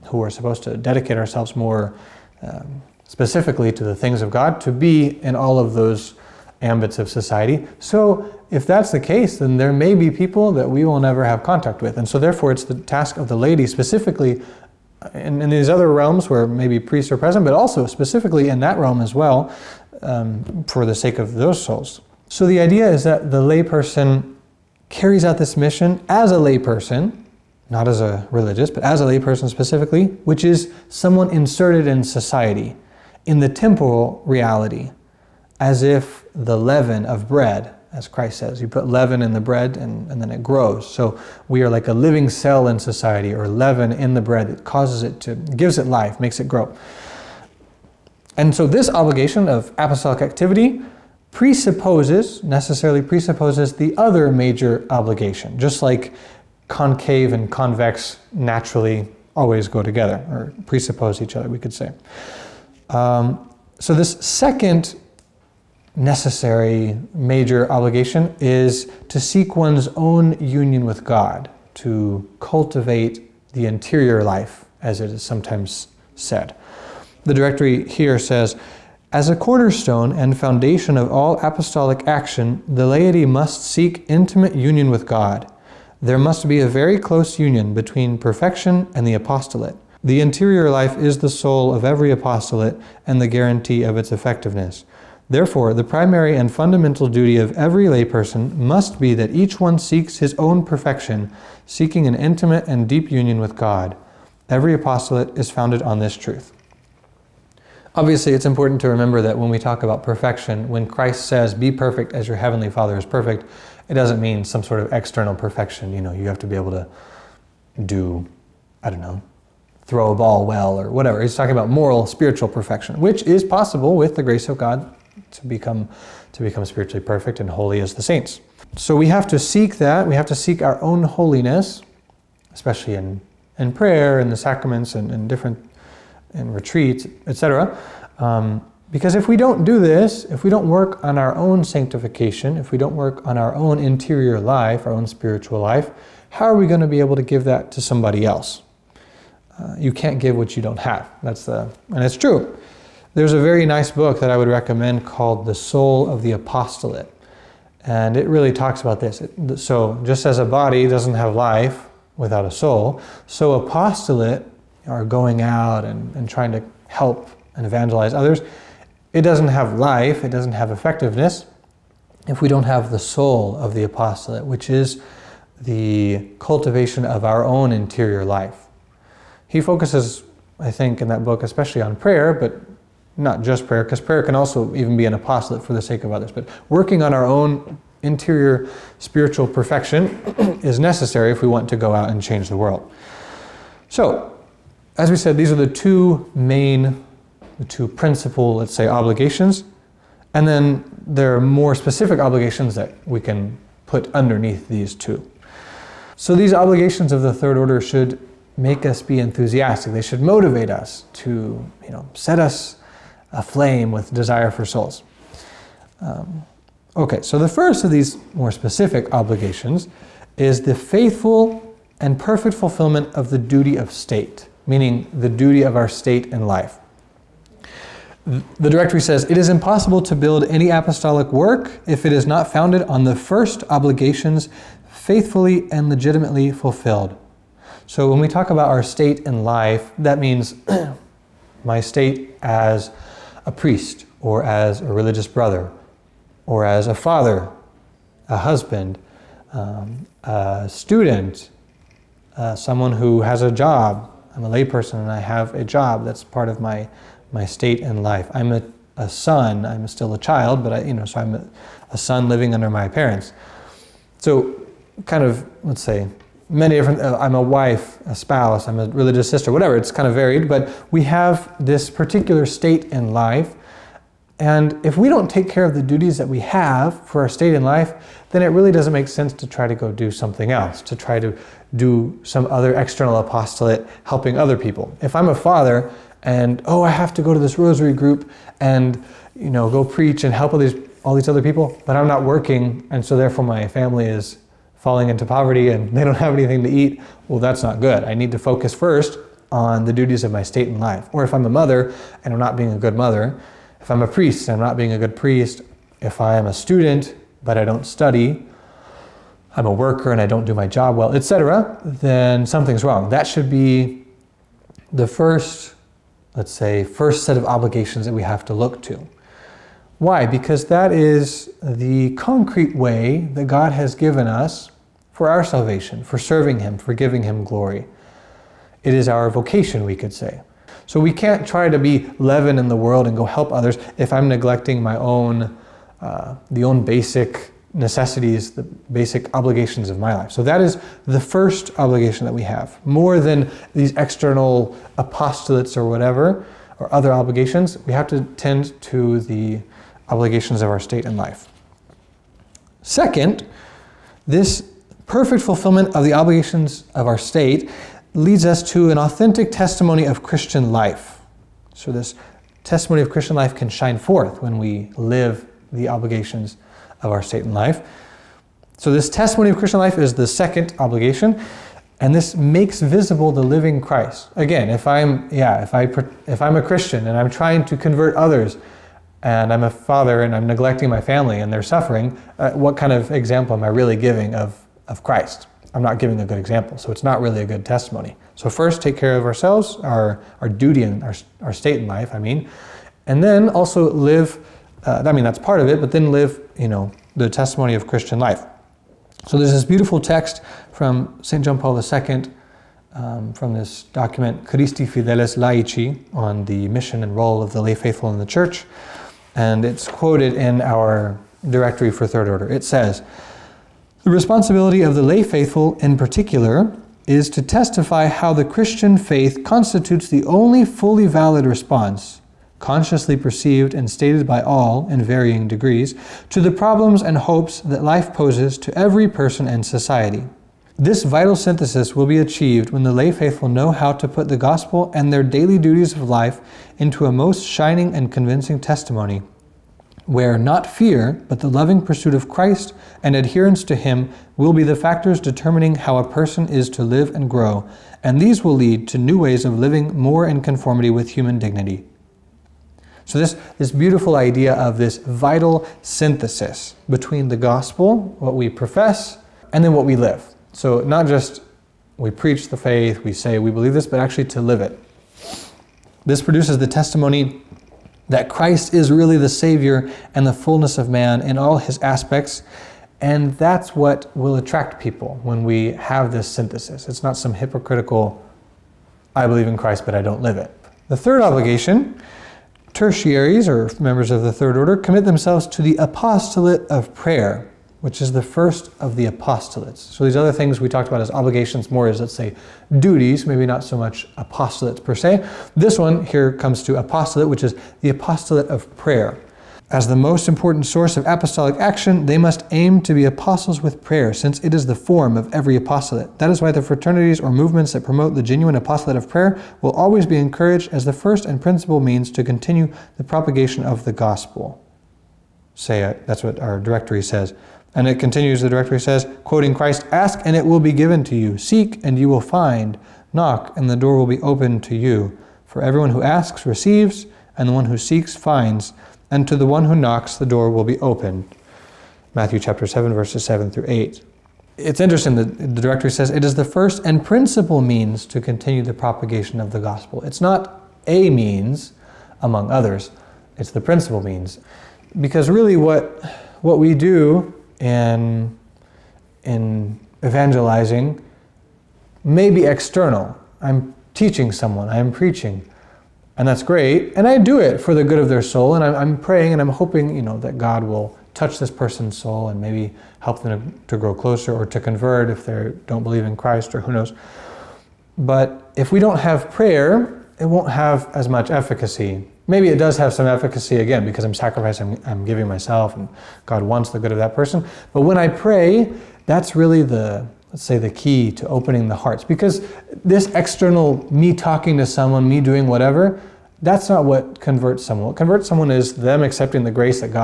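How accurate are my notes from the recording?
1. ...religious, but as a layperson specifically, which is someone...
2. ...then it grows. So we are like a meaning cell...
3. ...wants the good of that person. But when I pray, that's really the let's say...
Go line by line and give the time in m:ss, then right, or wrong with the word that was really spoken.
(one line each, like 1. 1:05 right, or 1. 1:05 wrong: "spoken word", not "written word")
1. 0:28 right
2. 0:40 wrong: "living", not "meaning"
3. 9:36 right.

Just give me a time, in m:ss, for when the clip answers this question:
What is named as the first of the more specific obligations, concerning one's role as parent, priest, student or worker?
3:43.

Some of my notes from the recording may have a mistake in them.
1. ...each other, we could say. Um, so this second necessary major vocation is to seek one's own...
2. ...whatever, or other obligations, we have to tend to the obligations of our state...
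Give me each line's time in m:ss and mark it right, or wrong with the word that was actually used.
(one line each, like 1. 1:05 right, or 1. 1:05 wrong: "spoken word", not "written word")
1. 1:01 wrong: "obligation", not "vocation"
2. 5:45 right.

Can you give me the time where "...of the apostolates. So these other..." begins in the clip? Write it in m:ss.
8:08.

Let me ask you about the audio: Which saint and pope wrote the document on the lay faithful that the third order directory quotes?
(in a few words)
St. John Paul II.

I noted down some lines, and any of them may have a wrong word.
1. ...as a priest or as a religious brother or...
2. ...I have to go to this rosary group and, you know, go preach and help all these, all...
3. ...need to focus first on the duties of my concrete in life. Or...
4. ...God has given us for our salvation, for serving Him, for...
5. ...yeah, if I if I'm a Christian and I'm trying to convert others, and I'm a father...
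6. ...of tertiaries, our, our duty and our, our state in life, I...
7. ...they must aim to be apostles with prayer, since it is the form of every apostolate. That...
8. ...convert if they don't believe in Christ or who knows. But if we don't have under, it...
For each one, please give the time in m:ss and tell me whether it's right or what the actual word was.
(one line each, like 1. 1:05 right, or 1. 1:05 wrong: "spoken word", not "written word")
1. 4:02 right
2. 4:46 right
3. 4:58 wrong: "state", not "concrete"
4. 5:23 right
5. 6:15 right
6. 6:29 wrong: "ourselves", not "tertiaries"
7. 8:22 right
8. 9:24 wrong: "prayer", not "under".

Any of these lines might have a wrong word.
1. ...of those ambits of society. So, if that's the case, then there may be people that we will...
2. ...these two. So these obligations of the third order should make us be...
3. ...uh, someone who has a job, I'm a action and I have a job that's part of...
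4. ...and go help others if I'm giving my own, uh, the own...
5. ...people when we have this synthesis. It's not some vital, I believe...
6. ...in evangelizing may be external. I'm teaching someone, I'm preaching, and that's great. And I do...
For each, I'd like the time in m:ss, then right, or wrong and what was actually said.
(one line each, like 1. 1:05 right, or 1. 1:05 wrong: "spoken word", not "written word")
1. 0:05 right
2. 3:24 right
3. 4:12 wrong: "layperson", not "action"
4. 5:33 wrong: "neglecting", not "giving"
5. 7:54 wrong: "hypocritical", not "vital"
6. 9:09 right.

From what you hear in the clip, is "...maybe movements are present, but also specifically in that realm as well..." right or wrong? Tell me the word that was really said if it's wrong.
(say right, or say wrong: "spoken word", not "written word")
wrong: "priests", not "movements".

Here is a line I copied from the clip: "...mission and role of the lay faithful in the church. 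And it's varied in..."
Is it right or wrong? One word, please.
wrong.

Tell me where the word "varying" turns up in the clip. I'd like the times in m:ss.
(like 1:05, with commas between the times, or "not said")
7:05.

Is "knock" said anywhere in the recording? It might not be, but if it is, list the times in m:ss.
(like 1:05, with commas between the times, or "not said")
8:43, 8:49.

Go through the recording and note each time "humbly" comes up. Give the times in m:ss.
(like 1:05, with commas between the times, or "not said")
not said.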